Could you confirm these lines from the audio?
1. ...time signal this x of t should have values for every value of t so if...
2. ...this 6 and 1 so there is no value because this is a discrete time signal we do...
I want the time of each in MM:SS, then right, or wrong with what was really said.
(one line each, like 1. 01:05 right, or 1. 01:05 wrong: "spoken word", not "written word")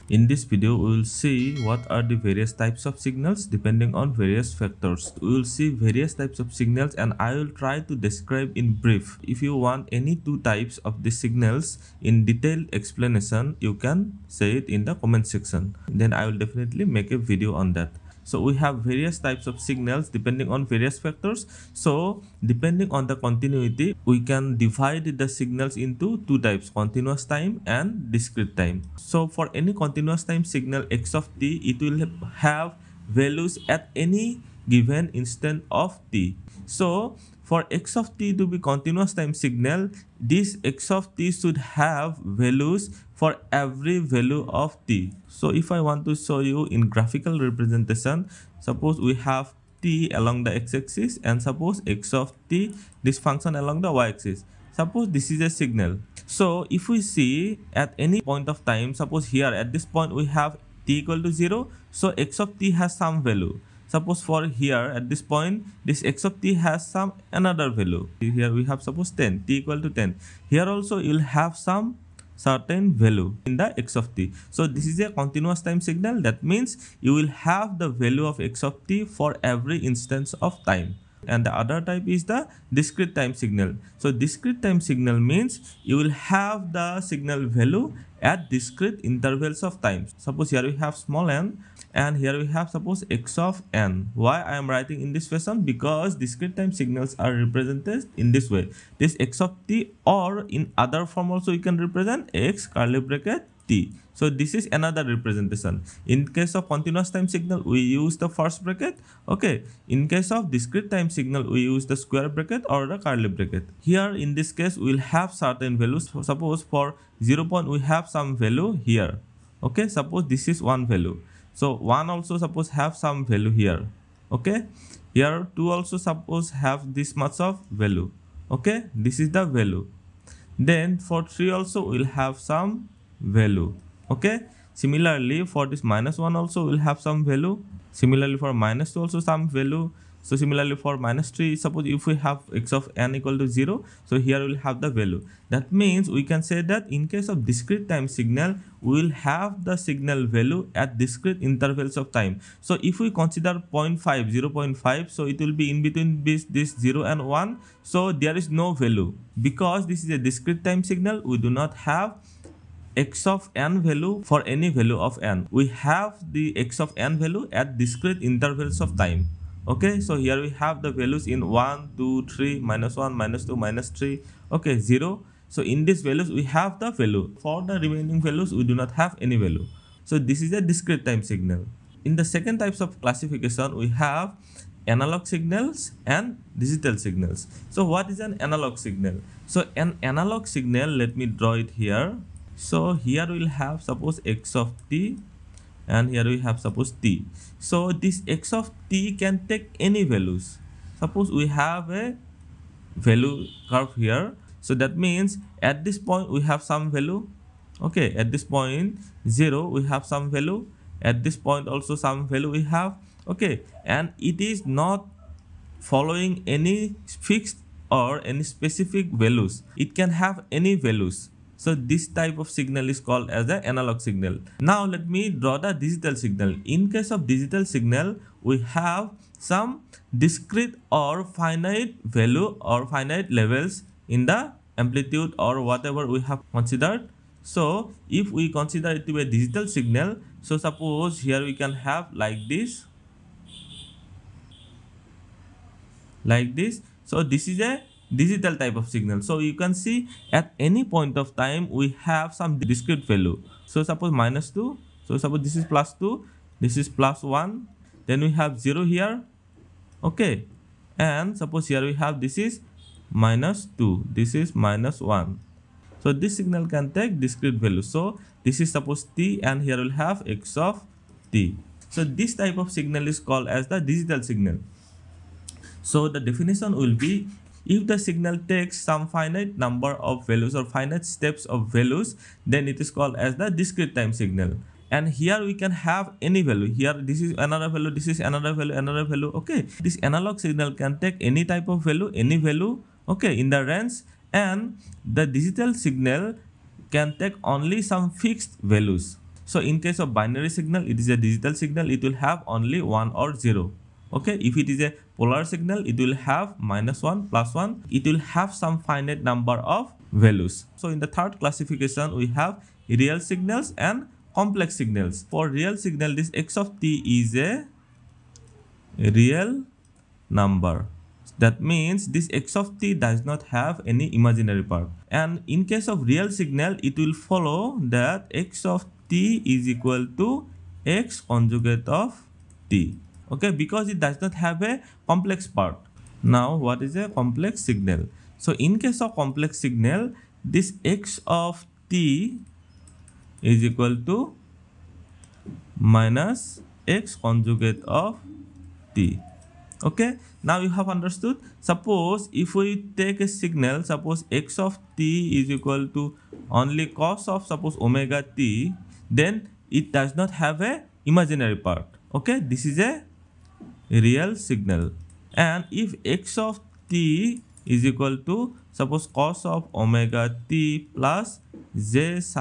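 1. 00:39 right
2. 02:36 wrong: "0", not "6".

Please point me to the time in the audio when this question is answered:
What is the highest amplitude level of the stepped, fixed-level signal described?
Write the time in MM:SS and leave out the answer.
04:15.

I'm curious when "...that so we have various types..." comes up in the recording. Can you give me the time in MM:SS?
00:17.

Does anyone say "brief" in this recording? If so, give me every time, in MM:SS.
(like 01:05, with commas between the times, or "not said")
00:08.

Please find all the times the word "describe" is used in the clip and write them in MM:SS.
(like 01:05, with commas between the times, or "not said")
00:07.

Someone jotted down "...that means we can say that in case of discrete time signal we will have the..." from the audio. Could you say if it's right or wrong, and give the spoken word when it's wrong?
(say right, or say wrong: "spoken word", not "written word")
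right.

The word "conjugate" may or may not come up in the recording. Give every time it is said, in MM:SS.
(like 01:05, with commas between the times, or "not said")
05:31, 05:47.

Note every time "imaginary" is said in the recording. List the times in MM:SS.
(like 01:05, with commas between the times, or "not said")
05:24, 06:01.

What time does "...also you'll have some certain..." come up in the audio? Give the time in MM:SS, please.
01:10.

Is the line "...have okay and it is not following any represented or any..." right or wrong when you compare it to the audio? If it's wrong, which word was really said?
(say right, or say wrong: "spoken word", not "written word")
wrong: "fixed", not "represented".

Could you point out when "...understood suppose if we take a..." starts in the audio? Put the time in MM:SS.
05:50.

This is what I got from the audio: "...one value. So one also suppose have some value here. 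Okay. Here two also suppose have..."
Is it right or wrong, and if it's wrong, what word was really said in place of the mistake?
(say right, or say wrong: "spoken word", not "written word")
right.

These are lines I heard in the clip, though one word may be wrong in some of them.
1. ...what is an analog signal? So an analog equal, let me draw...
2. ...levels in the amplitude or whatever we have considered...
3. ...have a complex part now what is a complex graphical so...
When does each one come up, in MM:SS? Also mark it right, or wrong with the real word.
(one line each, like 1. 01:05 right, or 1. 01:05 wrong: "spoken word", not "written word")
1. 03:07 wrong: "signal", not "equal"
2. 03:53 right
3. 05:34 wrong: "signal", not "graphical".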